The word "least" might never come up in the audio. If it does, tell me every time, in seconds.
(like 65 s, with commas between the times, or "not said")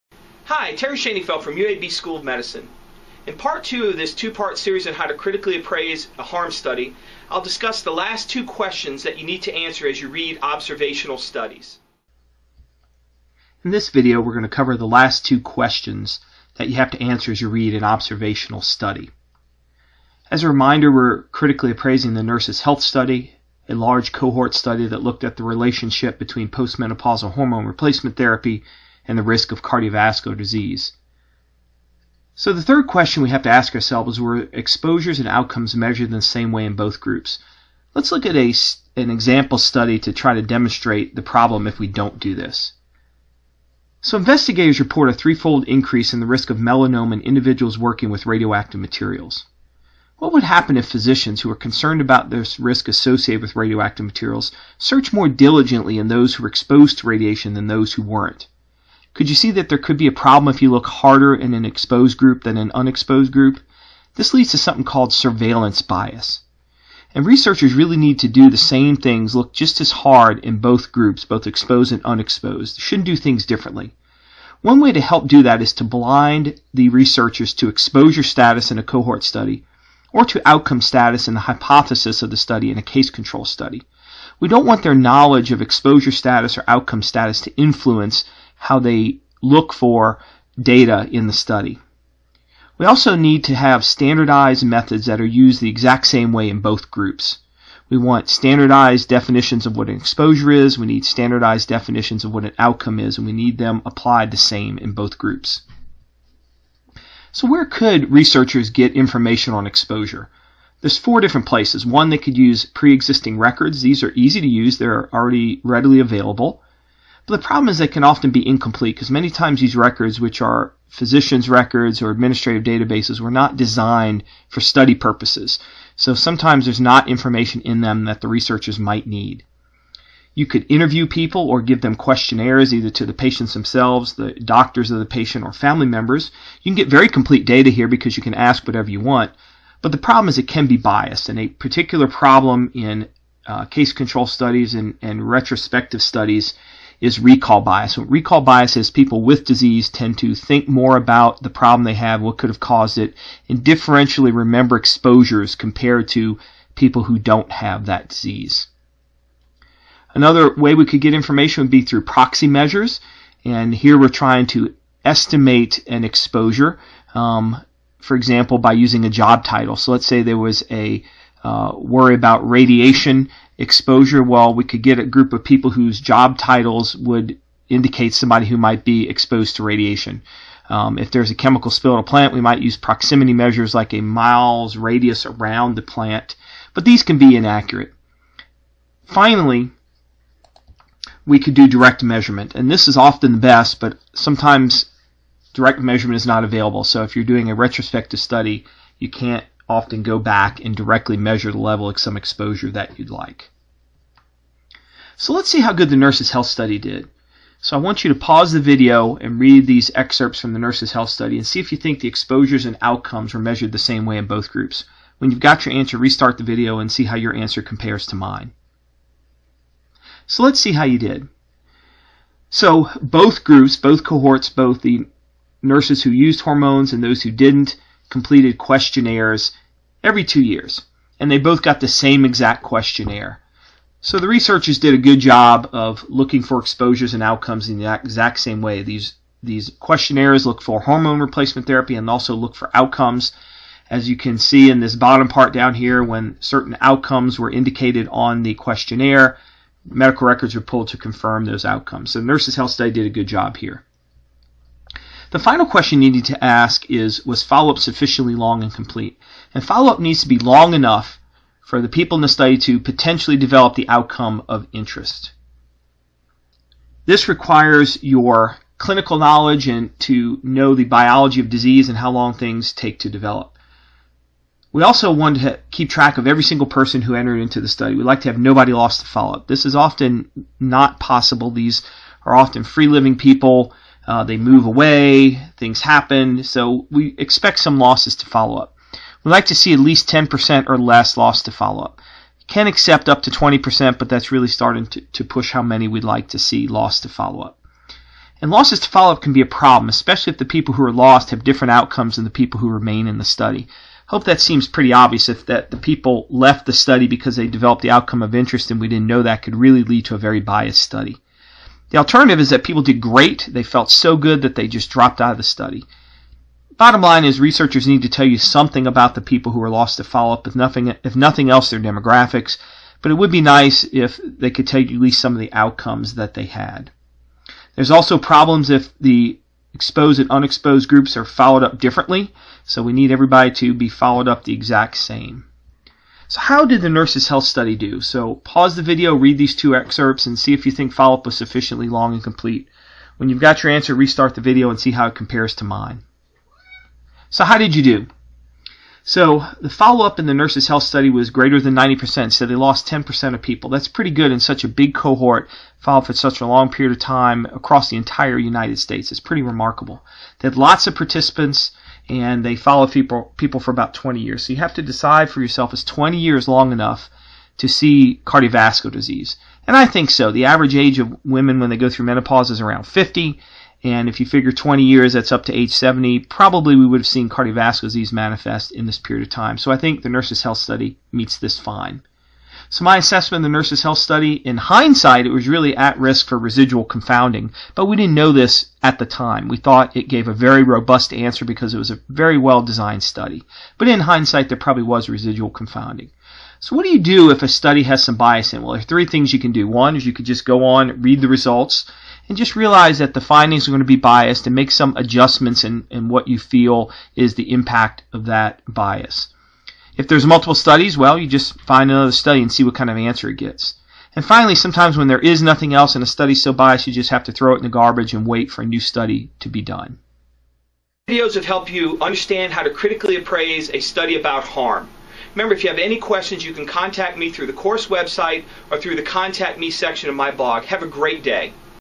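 289 s, 325 s.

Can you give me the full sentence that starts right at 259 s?
And follow-up needs to be long enough for the people in the study to potentially develop the outcome of interest.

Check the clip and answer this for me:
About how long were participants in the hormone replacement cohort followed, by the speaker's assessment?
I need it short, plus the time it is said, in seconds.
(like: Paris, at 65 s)
20 years, at 363 s.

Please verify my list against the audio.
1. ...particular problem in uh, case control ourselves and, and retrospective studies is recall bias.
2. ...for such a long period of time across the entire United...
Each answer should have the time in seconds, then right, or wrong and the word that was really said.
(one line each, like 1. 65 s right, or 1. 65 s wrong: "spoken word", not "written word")
1. 141 s wrong: "studies", not "ourselves"
2. 356 s right.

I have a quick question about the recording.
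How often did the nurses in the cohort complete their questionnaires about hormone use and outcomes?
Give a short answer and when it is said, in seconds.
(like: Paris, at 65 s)
every 2 years, at 230 s.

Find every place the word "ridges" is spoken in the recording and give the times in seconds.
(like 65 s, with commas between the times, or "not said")
not said.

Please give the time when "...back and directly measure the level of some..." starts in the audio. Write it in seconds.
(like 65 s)
200 s.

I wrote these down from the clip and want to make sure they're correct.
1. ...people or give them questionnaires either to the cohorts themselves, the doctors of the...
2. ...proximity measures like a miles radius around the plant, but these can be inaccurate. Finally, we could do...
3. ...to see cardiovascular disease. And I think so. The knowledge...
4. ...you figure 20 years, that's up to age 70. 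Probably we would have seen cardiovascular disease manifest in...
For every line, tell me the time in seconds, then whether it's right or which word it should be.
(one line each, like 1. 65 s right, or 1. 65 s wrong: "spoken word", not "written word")
1. 131 s wrong: "patients", not "cohorts"
2. 182 s right
3. 367 s wrong: "average", not "knowledge"
4. 374 s right.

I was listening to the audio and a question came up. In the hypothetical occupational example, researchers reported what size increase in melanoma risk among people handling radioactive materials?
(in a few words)
threefold.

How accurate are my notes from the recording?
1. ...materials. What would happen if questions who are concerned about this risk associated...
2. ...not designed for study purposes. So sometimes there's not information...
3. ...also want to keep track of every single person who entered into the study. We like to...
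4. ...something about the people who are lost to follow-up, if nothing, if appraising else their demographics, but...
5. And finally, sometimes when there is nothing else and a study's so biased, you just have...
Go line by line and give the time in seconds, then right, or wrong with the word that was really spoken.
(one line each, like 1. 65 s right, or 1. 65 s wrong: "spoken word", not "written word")
1. 48 s wrong: "physicians", not "questions"
2. 123 s right
3. 274 s right
4. 318 s wrong: "nothing", not "appraising"
5. 414 s right.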